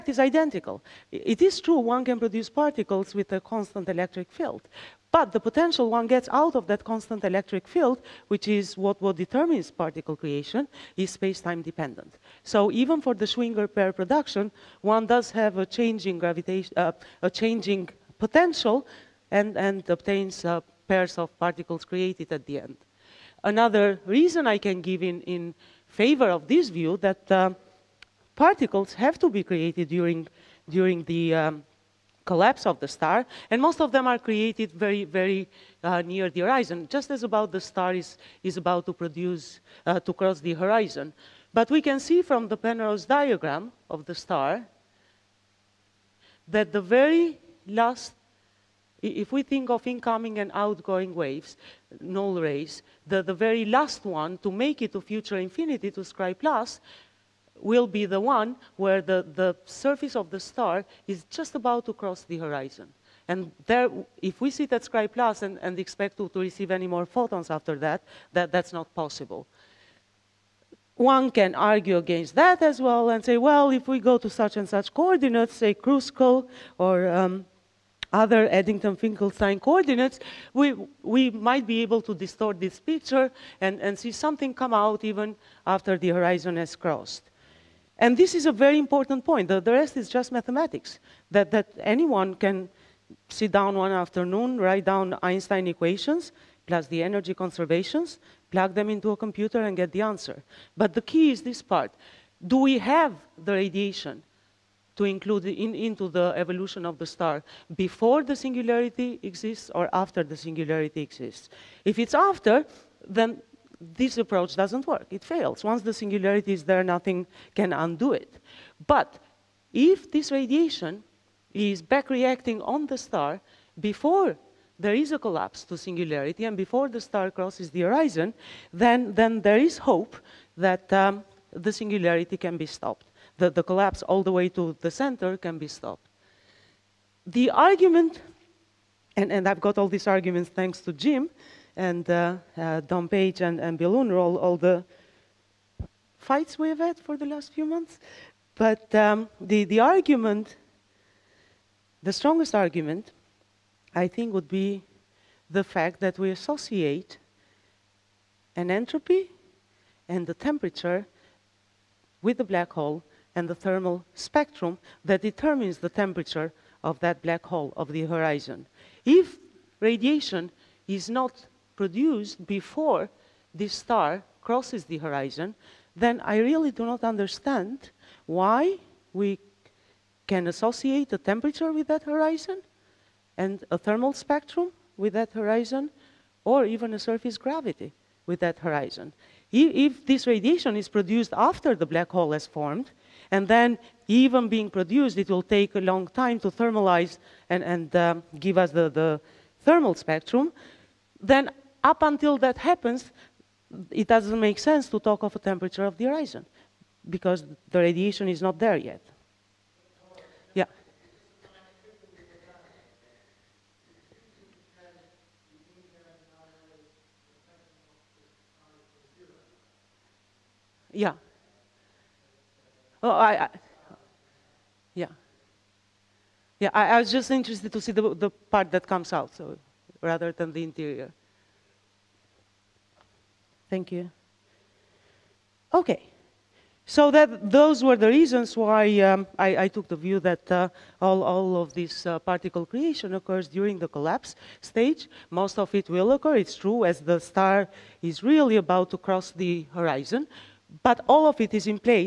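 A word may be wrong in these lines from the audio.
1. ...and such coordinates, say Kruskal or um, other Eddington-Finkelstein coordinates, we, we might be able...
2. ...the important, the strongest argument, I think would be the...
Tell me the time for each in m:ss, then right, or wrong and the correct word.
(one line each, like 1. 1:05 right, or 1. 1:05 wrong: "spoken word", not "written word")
1. 1:14 right
2. 2:29 wrong: "argument", not "important".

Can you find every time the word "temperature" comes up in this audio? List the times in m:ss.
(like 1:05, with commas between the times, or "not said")
2:40, 2:45, 3:01, 3:25.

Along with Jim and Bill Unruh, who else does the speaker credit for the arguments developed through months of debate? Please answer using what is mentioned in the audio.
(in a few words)
Don Page.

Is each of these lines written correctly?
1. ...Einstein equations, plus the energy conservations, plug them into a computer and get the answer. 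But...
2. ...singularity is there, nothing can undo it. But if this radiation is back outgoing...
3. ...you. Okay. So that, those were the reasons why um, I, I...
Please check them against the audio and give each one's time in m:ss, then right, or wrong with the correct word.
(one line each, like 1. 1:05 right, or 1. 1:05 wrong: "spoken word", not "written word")
1. 1:35 right
2. 1:56 wrong: "reacting", not "outgoing"
3. 3:53 right.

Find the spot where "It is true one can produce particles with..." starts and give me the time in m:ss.
0:01.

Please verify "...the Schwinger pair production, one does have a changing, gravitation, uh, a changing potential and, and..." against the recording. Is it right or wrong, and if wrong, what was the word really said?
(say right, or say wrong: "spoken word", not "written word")
right.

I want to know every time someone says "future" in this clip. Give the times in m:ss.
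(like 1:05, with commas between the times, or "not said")
0:54.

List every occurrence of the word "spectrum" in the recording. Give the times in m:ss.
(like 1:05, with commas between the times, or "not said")
2:44, 3:04, 3:19.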